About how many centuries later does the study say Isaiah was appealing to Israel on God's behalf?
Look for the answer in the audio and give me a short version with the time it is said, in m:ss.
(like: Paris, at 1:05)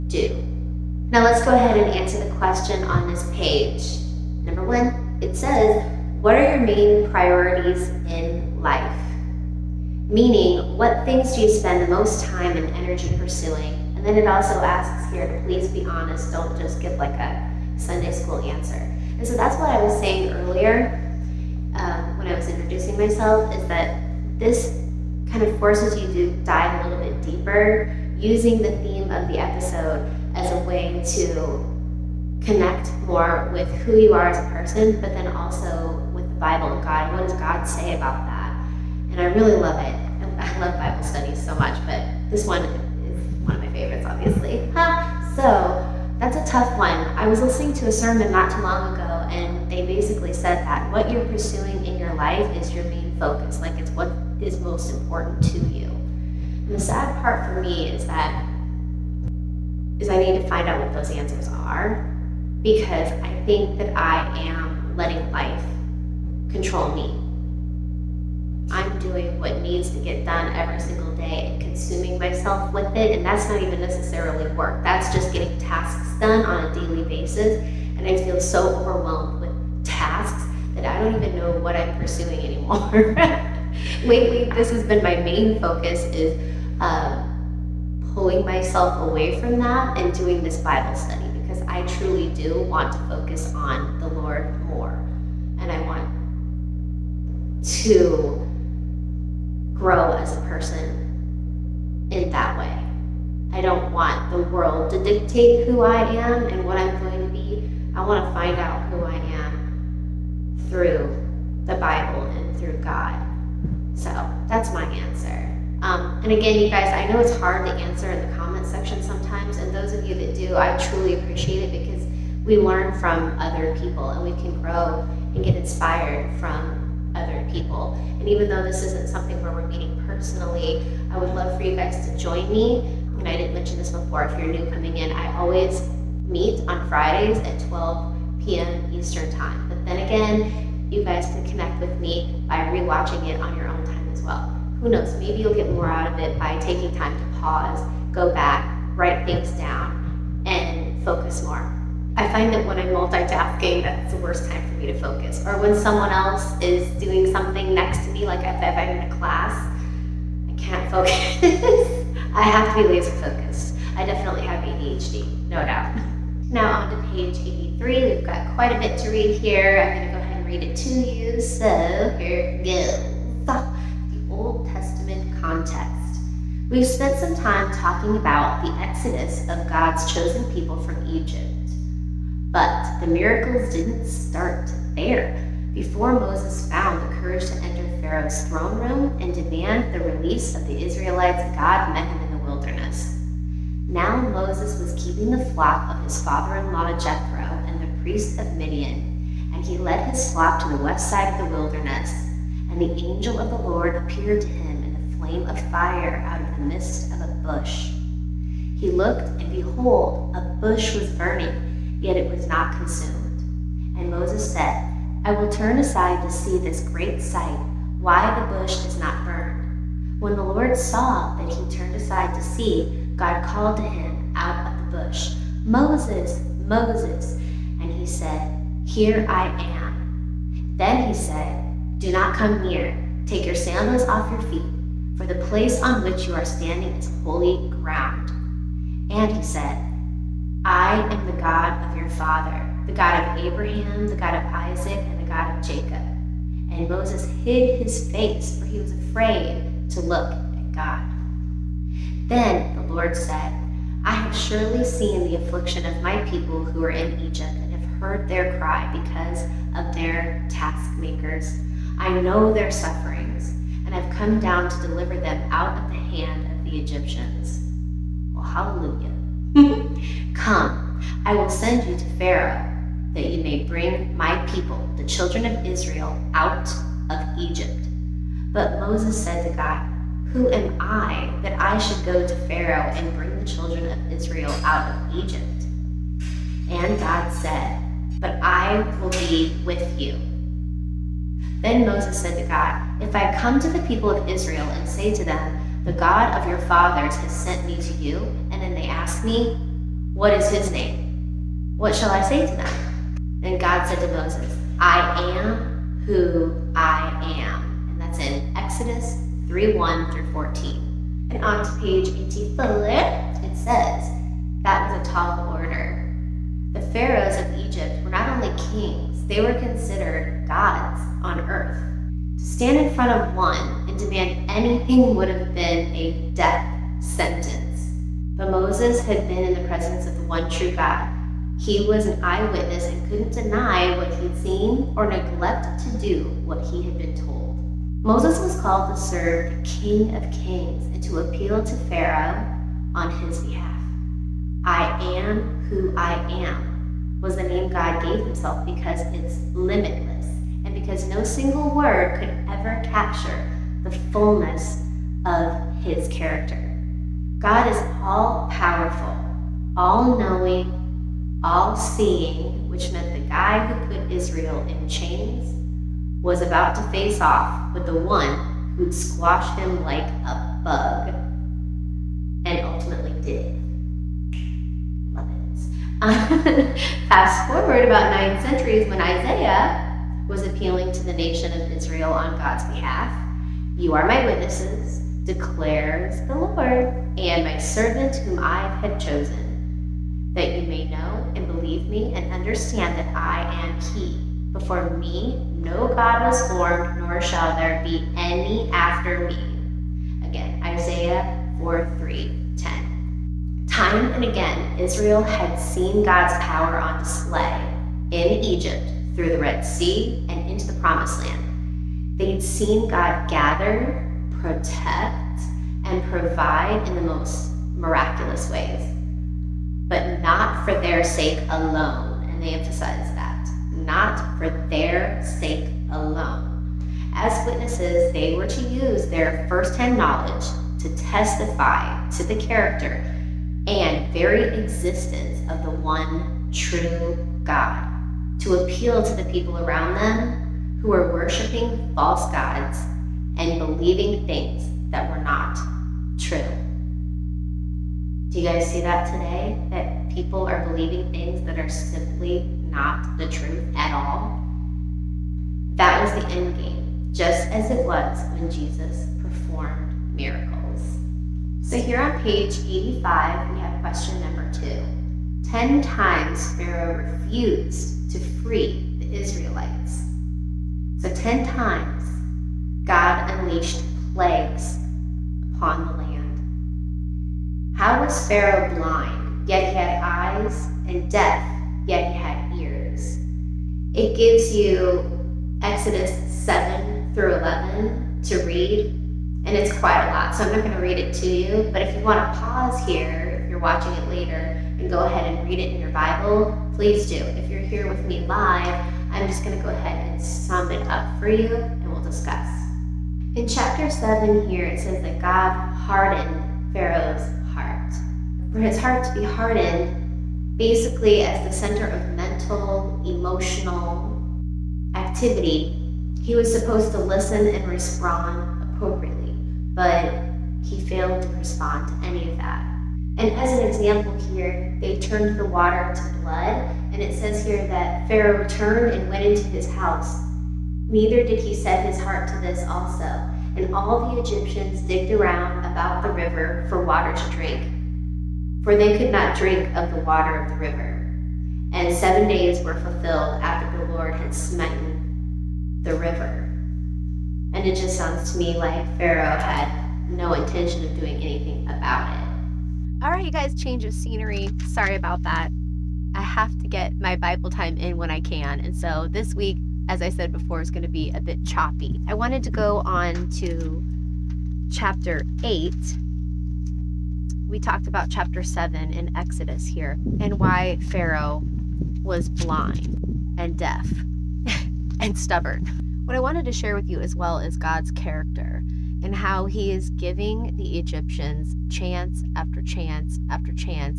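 9, at 6:18.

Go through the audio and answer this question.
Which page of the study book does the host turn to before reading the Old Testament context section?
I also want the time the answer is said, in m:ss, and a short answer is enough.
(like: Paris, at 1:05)
83, at 2:47.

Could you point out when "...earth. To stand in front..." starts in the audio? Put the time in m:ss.
5:21.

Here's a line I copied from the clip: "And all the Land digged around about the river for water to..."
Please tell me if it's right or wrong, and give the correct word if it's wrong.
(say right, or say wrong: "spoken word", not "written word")
wrong: "Egyptians", not "Land".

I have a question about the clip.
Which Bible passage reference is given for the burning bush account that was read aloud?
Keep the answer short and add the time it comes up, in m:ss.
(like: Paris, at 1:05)
Exodus 3:1-14, at 5:08.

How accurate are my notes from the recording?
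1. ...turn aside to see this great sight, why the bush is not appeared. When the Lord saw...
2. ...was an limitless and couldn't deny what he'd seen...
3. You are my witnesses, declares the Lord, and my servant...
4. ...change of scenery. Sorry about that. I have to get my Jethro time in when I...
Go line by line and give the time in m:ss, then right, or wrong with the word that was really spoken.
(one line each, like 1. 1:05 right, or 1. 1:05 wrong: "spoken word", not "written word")
1. 3:35 wrong: "burned", not "appeared"
2. 5:31 wrong: "eyewitness", not "limitless"
3. 6:23 right
4. 9:13 wrong: "Bible", not "Jethro".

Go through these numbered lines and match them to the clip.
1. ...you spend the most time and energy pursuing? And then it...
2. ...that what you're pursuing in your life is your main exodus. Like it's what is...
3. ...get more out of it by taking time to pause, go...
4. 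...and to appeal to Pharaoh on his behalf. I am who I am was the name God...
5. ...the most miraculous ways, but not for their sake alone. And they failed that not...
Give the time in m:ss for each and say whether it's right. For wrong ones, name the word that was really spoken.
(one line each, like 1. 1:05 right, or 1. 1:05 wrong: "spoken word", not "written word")
1. 0:11 right
2. 0:50 wrong: "focus", not "exodus"
3. 2:25 right
4. 5:40 right
5. 6:56 wrong: "emphasized", not "failed".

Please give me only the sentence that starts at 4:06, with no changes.
And Moses hid his face, for he was afraid to look at God.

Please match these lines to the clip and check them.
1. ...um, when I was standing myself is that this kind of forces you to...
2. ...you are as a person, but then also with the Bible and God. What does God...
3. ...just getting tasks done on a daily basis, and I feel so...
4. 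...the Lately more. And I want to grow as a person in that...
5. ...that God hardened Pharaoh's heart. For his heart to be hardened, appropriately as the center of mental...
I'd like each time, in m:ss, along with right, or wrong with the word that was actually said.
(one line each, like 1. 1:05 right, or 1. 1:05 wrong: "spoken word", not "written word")
1. 0:21 wrong: "introducing", not "standing"
2. 0:33 right
3. 1:15 right
4. 1:33 wrong: "Lord", not "Lately"
5. 8:25 wrong: "basically", not "appropriately".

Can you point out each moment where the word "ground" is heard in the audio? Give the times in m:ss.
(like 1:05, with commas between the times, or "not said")
3:57.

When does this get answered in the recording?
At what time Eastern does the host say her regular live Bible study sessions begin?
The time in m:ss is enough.
2:17.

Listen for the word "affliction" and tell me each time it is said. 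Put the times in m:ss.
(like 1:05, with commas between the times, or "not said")
4:15.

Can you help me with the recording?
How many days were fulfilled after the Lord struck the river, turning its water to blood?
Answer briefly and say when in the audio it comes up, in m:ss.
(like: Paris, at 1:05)
7, at 9:01.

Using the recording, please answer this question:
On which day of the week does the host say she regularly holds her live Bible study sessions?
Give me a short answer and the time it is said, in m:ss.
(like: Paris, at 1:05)
Fridays, at 2:16.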